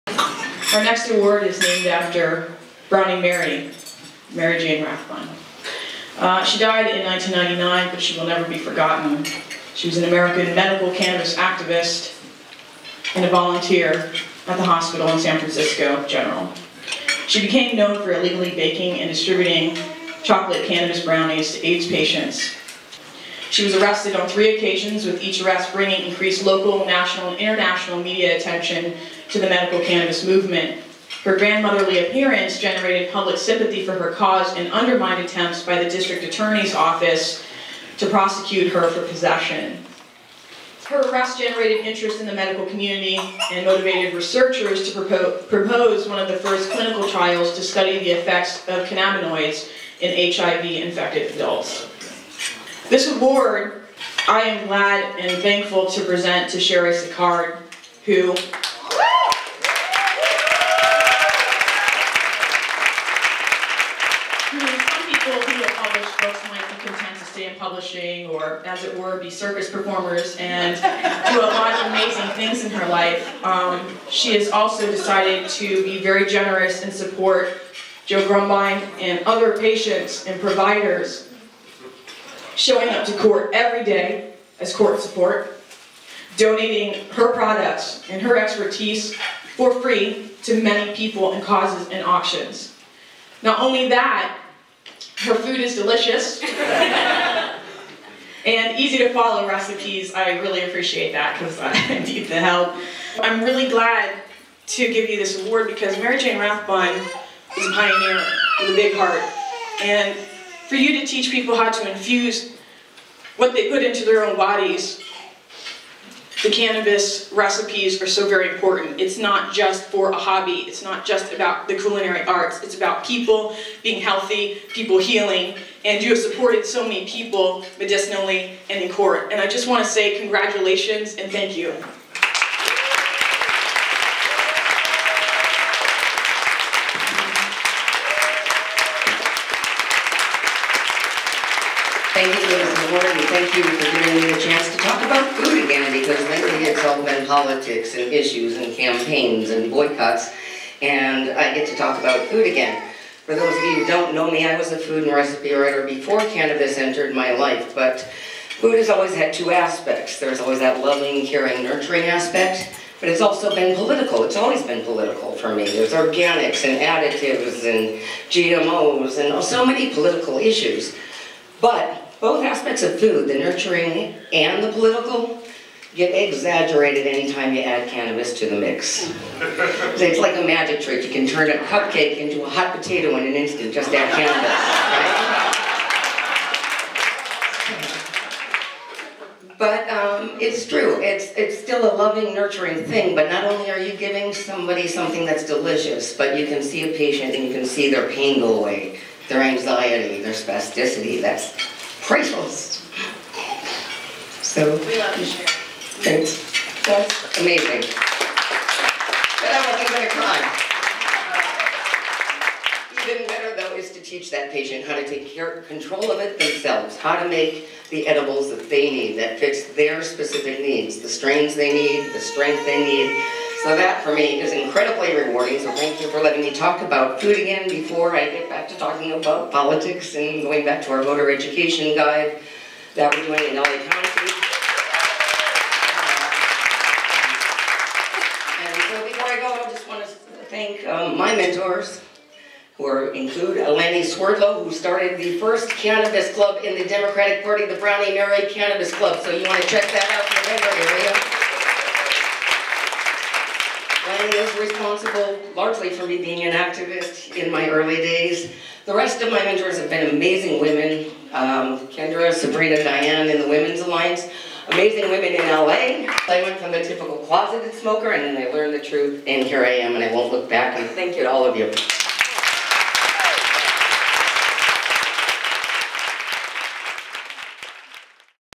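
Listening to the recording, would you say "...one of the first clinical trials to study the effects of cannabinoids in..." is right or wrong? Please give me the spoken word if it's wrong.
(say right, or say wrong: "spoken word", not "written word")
right.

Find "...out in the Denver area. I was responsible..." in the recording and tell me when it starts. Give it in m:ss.
4:10.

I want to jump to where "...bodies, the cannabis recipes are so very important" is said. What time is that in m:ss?
1:54.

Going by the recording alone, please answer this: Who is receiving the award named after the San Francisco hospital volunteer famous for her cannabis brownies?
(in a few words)
Cheri Sicard.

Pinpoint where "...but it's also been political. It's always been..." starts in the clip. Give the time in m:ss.
2:42.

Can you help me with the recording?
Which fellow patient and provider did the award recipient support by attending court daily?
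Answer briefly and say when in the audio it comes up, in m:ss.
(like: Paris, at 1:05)
Joe Grumbine, at 1:18.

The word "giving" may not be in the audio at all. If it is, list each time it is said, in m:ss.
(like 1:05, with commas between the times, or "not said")
2:23, 3:13.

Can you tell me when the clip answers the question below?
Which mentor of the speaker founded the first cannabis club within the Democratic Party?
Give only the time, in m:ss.
4:03.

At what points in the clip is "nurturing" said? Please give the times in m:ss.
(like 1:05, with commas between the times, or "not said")
2:41, 2:53, 3:12.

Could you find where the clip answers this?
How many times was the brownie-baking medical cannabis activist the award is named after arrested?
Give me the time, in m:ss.
0:24.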